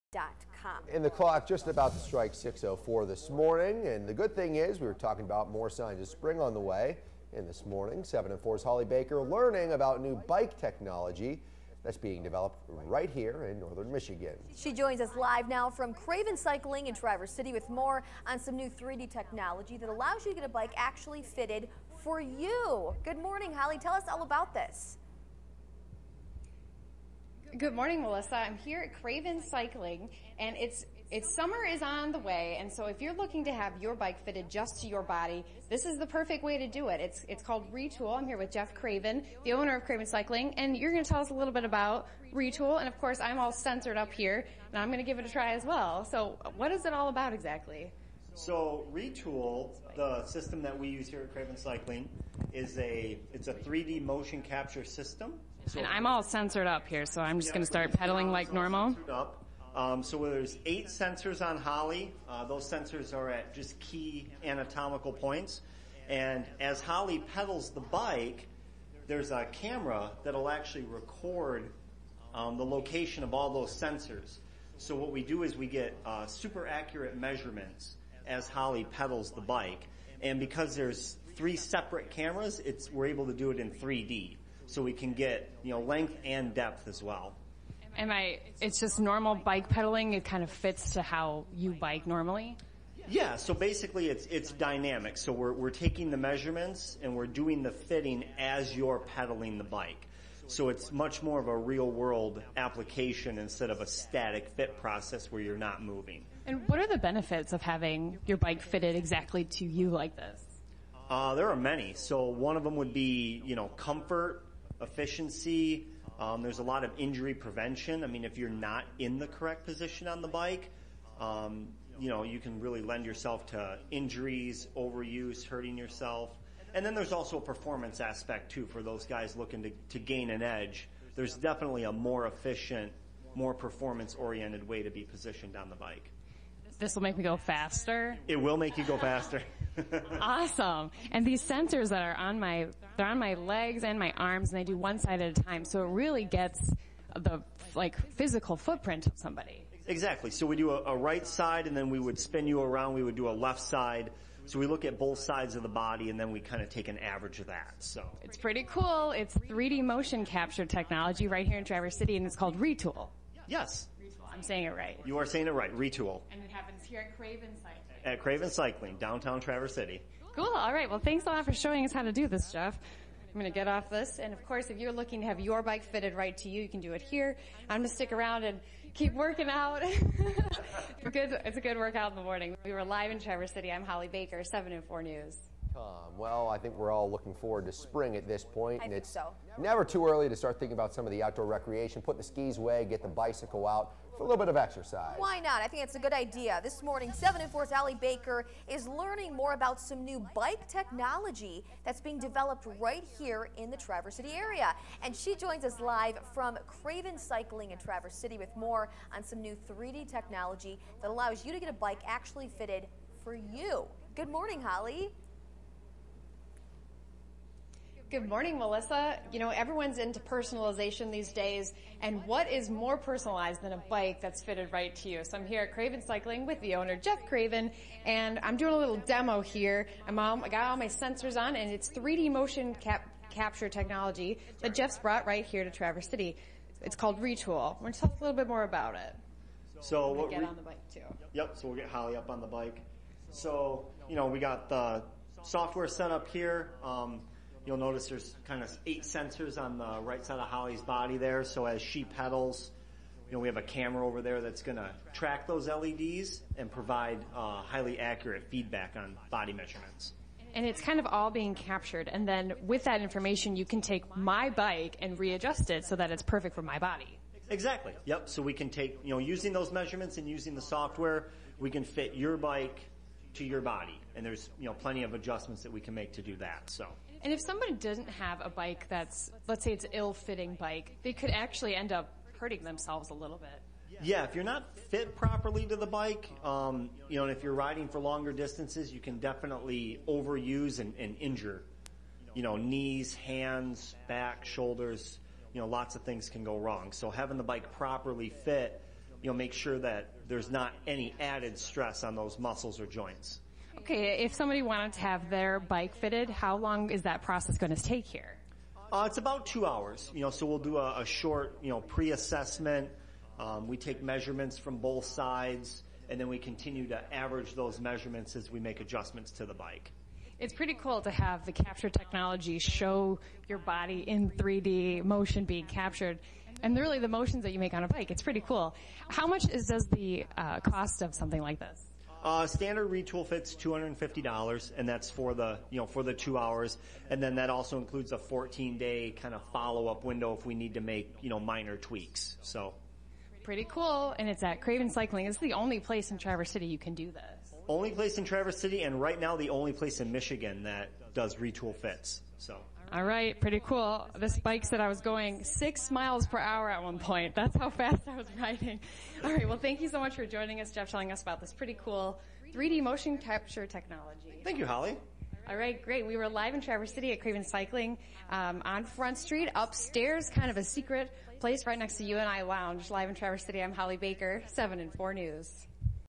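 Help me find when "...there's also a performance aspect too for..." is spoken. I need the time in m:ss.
2:06.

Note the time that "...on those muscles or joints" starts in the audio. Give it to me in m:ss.
5:02.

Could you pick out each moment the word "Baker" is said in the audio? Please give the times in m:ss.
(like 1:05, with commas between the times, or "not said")
0:08, 3:04, 3:17, 6:13.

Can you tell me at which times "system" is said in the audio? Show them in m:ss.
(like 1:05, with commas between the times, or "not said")
0:50, 0:54.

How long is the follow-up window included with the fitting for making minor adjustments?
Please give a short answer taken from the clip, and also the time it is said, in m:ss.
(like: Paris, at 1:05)
14 days, at 5:38.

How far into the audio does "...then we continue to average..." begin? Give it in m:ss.
5:16.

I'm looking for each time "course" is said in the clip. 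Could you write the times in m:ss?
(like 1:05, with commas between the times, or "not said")
0:43, 2:54.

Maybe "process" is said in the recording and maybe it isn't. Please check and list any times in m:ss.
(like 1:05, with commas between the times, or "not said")
1:44, 5:07.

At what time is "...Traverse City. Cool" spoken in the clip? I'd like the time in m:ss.
2:49.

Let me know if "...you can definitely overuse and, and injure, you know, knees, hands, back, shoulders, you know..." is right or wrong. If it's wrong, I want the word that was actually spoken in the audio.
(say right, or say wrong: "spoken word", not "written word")
right.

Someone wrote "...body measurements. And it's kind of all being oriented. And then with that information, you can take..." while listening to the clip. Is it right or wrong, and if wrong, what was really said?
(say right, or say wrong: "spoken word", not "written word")
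wrong: "captured", not "oriented".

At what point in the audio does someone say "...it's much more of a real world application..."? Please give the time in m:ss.
1:40.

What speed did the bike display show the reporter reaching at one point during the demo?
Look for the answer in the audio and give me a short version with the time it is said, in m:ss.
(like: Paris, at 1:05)
6 miles per hour, at 5:55.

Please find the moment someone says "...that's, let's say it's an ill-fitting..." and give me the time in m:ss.
4:38.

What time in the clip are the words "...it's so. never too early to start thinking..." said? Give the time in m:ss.
3:08.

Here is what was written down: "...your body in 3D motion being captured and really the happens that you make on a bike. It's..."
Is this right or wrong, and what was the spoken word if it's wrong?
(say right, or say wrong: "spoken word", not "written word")
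wrong: "motions", not "happens".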